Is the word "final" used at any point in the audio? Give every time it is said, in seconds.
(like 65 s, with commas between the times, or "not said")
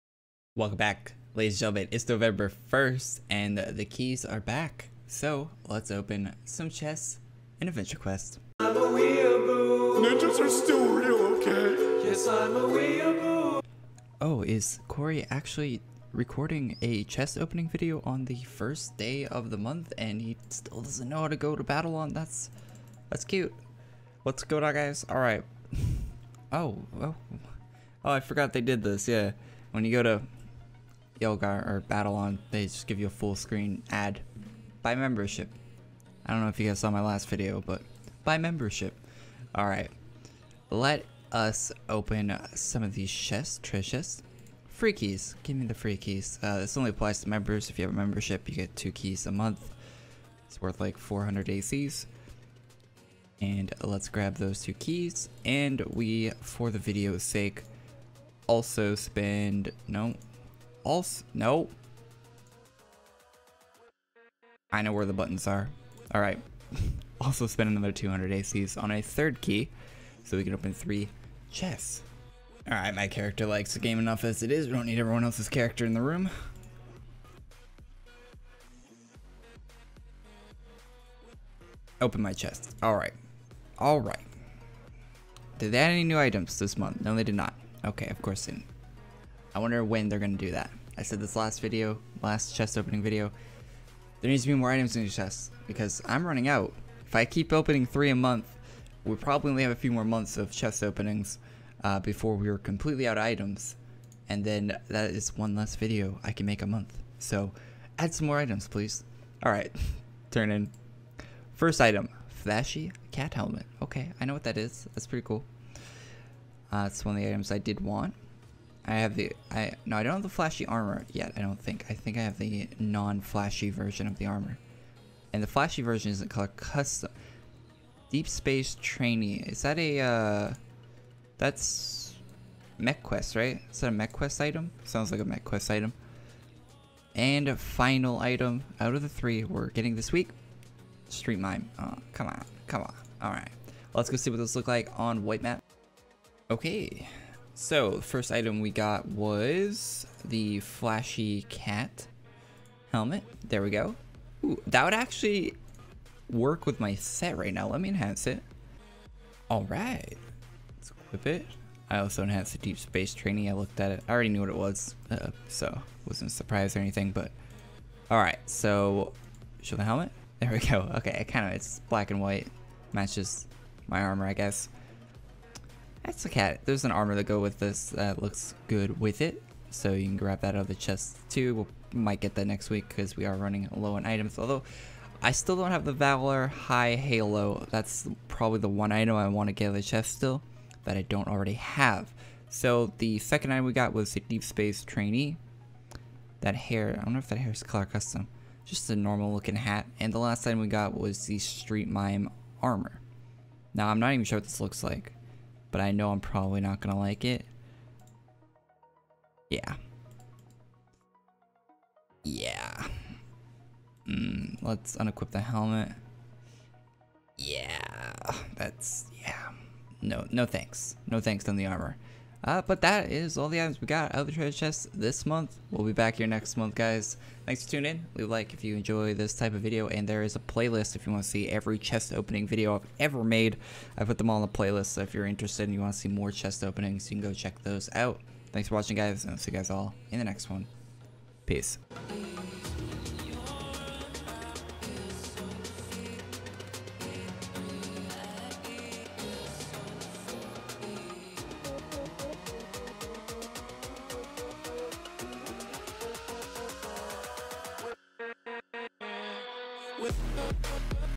137 s.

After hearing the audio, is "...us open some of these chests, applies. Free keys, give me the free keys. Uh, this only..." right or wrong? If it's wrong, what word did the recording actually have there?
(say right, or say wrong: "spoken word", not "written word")
wrong: "treasures", not "applies".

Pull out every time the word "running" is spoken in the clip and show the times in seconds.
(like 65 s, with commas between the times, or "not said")
96 s, 183 s.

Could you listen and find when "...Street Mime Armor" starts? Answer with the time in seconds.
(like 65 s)
201 s.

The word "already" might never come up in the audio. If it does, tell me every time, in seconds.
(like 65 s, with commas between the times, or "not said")
164 s, 191 s.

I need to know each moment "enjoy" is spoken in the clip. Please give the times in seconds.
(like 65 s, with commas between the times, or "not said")
228 s.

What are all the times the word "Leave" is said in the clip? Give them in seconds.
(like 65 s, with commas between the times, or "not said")
228 s.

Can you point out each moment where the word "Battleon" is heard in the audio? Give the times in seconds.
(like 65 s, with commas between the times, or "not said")
21 s, 31 s.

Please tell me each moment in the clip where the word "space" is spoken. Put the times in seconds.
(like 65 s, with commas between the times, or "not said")
128 s, 162 s, 194 s.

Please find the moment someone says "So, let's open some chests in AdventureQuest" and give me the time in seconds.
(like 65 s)
5 s.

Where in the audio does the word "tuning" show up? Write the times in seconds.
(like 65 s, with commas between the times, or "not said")
227 s.